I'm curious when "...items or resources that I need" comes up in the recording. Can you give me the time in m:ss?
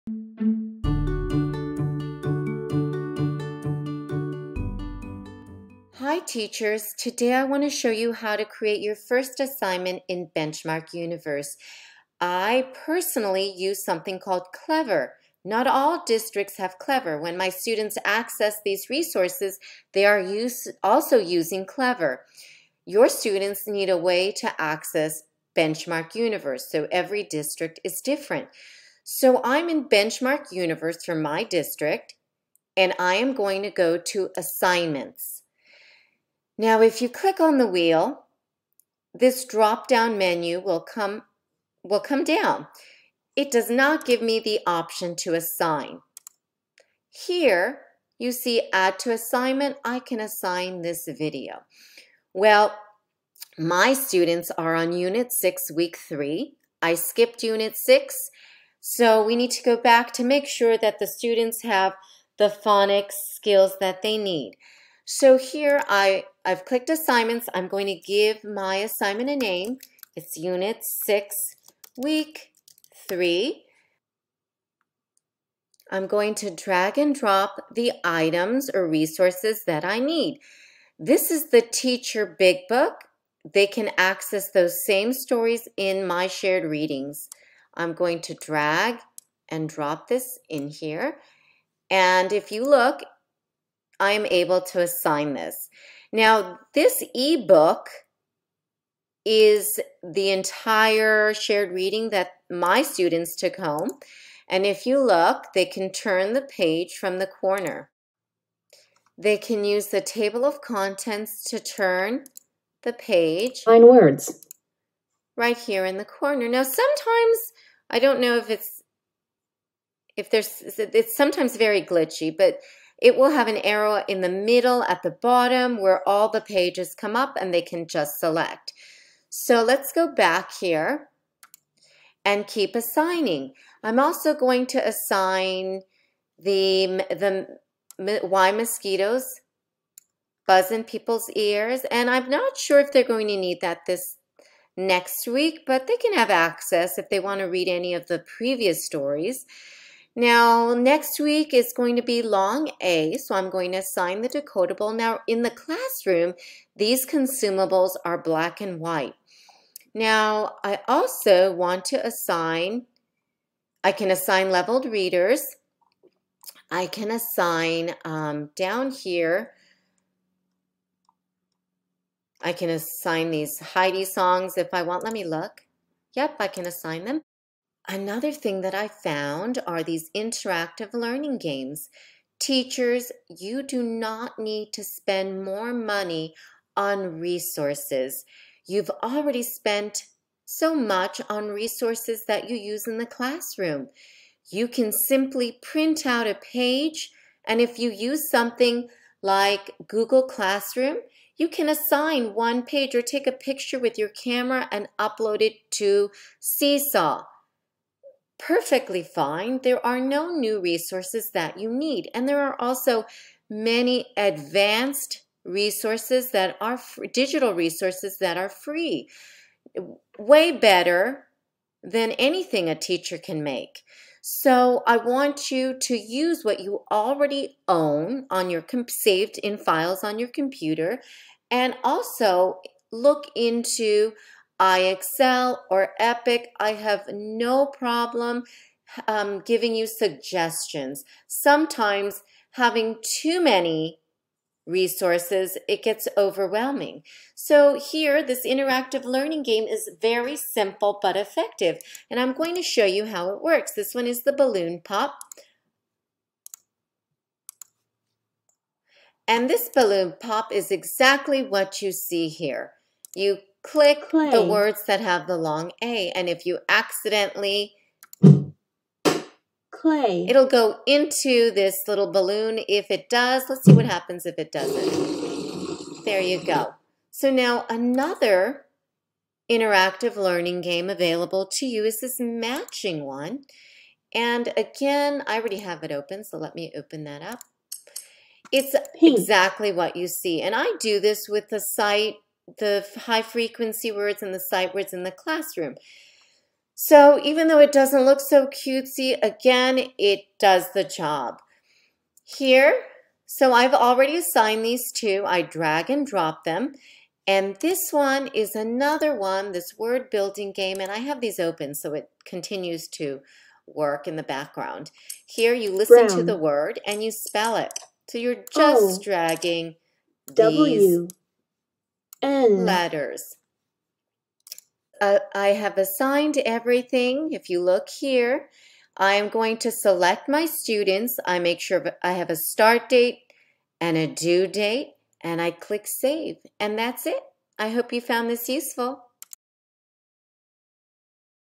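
1:18.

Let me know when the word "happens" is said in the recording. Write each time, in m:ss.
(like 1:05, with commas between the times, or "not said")
4:33.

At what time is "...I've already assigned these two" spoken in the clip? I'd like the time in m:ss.
5:03.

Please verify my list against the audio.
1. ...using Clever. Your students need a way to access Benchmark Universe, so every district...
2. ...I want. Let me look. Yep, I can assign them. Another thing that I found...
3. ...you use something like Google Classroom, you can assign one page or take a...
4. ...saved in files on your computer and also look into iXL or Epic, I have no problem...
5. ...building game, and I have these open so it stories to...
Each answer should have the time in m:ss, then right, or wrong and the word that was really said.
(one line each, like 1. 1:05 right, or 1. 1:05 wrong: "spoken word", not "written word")
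1. 0:21 right
2. 2:54 right
3. 3:17 right
4. 3:48 right
5. 5:10 wrong: "continues", not "stories".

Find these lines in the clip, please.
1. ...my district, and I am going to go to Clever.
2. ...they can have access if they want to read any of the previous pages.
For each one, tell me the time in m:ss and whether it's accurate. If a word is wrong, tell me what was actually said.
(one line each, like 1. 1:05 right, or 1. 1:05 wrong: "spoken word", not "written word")
1. 0:31 wrong: "Assignments", not "Clever"
2. 2:25 wrong: "stories", not "pages".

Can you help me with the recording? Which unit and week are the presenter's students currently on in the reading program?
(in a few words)
Unit 6, Week 3.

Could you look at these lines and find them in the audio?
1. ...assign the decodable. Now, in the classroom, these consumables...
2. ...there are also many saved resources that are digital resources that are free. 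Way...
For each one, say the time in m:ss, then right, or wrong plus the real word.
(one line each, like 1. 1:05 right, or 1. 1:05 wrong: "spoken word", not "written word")
1. 2:33 right
2. 3:32 wrong: "advanced", not "saved".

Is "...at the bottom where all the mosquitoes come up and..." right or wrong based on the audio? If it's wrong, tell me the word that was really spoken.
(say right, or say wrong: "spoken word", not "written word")
wrong: "pages", not "mosquitoes".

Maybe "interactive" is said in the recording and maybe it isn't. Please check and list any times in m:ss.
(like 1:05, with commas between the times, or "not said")
3:00, 4:08, 4:39.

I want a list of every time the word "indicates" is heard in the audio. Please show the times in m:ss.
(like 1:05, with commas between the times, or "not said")
not said.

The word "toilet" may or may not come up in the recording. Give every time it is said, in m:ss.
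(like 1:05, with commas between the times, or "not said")
not said.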